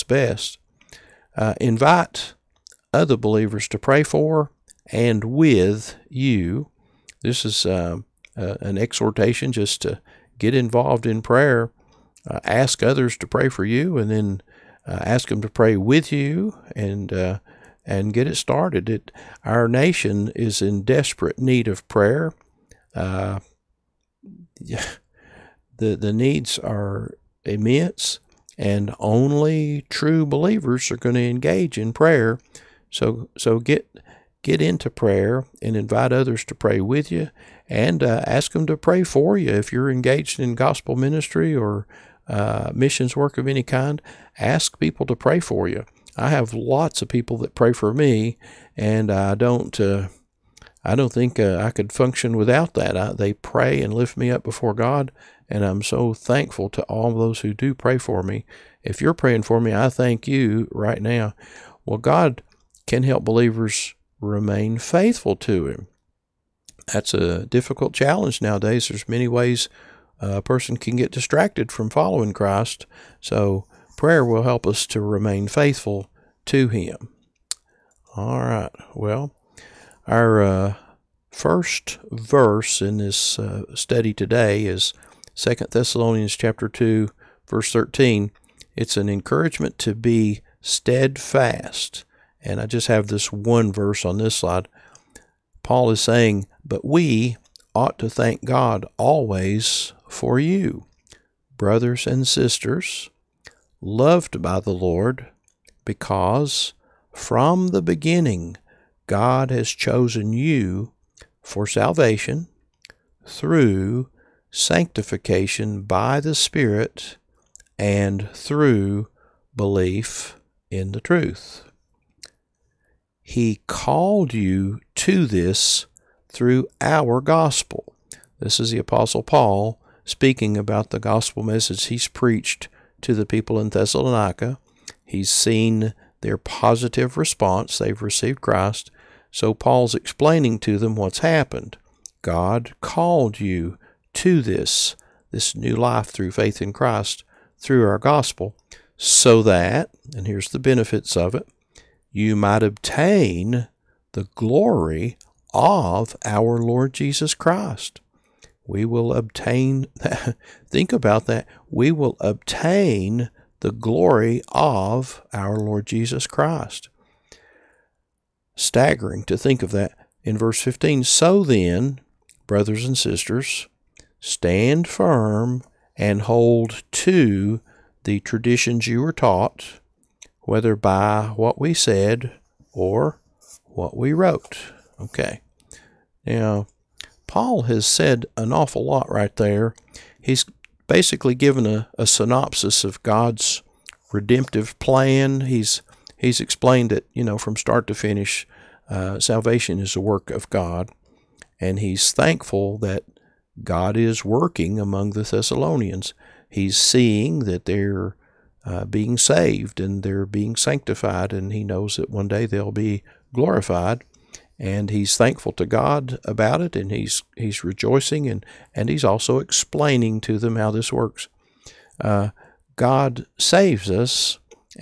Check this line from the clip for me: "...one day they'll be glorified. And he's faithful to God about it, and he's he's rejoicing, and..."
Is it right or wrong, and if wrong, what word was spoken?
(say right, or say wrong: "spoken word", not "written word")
wrong: "thankful", not "faithful".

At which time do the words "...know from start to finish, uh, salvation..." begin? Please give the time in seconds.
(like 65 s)
197 s.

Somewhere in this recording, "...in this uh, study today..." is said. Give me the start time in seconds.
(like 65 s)
82 s.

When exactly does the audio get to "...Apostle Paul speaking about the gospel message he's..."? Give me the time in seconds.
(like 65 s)
128 s.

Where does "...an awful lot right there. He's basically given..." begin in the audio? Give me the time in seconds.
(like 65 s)
188 s.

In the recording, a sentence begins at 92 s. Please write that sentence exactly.
And I just have this one verse on this slide.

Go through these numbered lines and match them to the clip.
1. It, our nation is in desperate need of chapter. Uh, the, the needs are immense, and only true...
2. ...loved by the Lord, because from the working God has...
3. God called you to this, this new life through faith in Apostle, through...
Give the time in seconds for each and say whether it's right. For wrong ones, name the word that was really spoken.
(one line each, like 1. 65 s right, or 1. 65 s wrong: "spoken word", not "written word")
1. 18 s wrong: "prayer", not "chapter"
2. 103 s wrong: "beginning", not "working"
3. 142 s wrong: "Christ", not "Apostle".